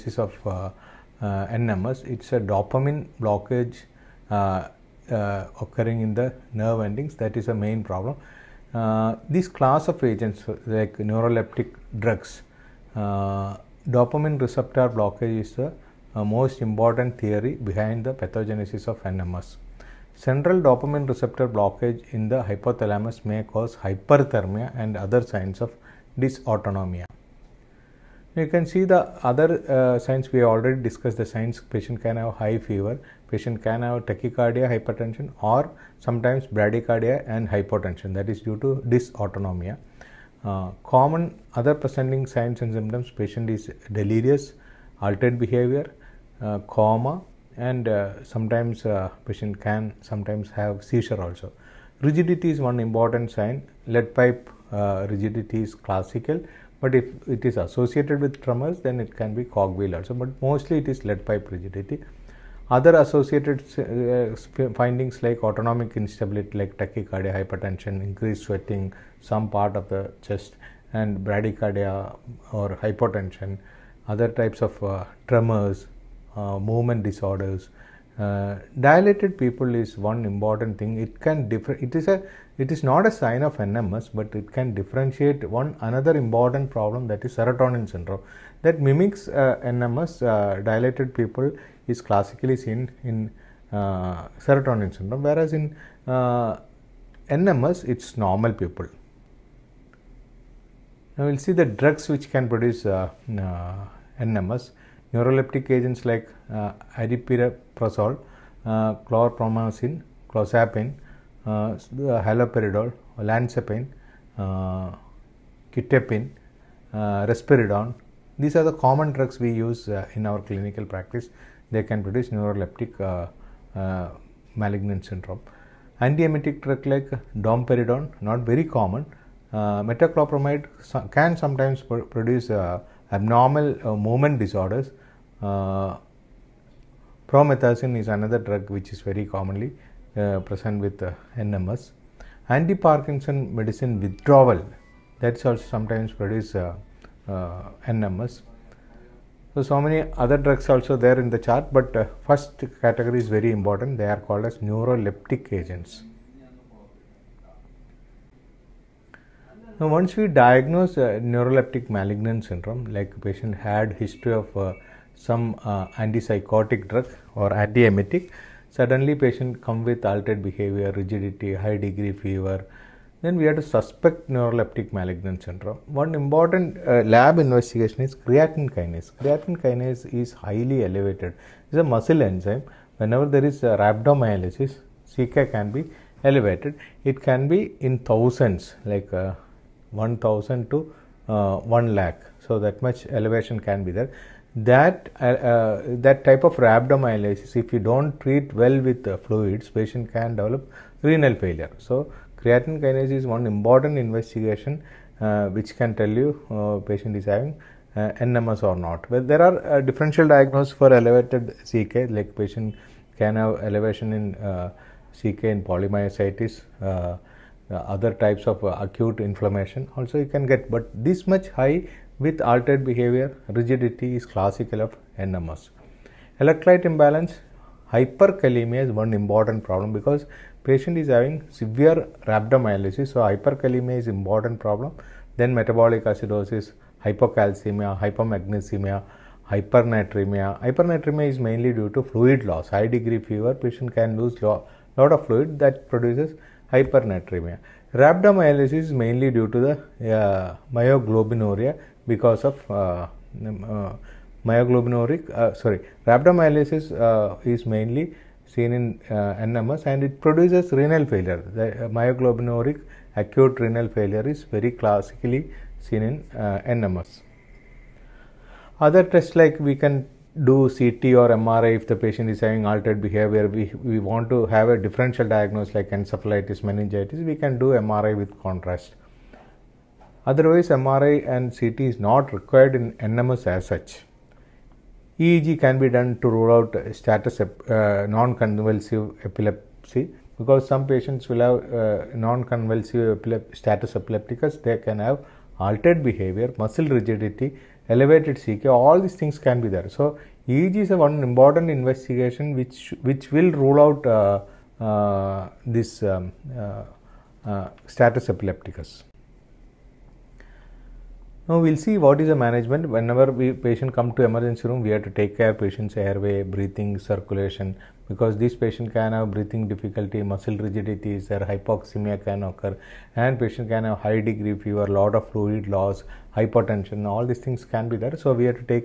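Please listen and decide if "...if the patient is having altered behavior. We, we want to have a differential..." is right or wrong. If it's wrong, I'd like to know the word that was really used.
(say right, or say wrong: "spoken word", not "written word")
right.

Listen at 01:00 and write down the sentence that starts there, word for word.
But mostly it is lead pipe rigidity.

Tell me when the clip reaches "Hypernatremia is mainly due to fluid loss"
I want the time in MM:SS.
04:00.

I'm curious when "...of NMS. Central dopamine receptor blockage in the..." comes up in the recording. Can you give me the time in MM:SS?
00:18.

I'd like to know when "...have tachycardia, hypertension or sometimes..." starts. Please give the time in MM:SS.
00:33.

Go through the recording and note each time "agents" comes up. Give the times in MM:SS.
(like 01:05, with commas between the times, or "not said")
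00:10, 01:45, 02:35.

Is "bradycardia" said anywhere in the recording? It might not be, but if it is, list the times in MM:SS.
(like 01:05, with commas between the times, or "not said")
00:36, 01:11.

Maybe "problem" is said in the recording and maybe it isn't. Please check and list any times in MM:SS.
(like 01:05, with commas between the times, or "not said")
00:07, 01:26, 03:49, 03:54.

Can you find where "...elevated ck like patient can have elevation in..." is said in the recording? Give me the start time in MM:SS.
03:30.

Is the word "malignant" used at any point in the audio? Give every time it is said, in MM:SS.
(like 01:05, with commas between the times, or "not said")
02:04, 02:41, 02:54.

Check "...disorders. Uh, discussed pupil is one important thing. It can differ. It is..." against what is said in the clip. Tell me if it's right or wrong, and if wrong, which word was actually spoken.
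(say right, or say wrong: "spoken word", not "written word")
wrong: "dilated", not "discussed".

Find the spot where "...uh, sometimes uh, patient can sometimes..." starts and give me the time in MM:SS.
00:47.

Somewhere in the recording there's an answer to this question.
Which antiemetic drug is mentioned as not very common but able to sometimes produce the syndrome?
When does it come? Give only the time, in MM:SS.
02:07.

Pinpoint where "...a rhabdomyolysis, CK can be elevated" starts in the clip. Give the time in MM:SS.
03:03.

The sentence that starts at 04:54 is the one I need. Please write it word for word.
They can have altered behavior, muscle rigidity, elevated CK.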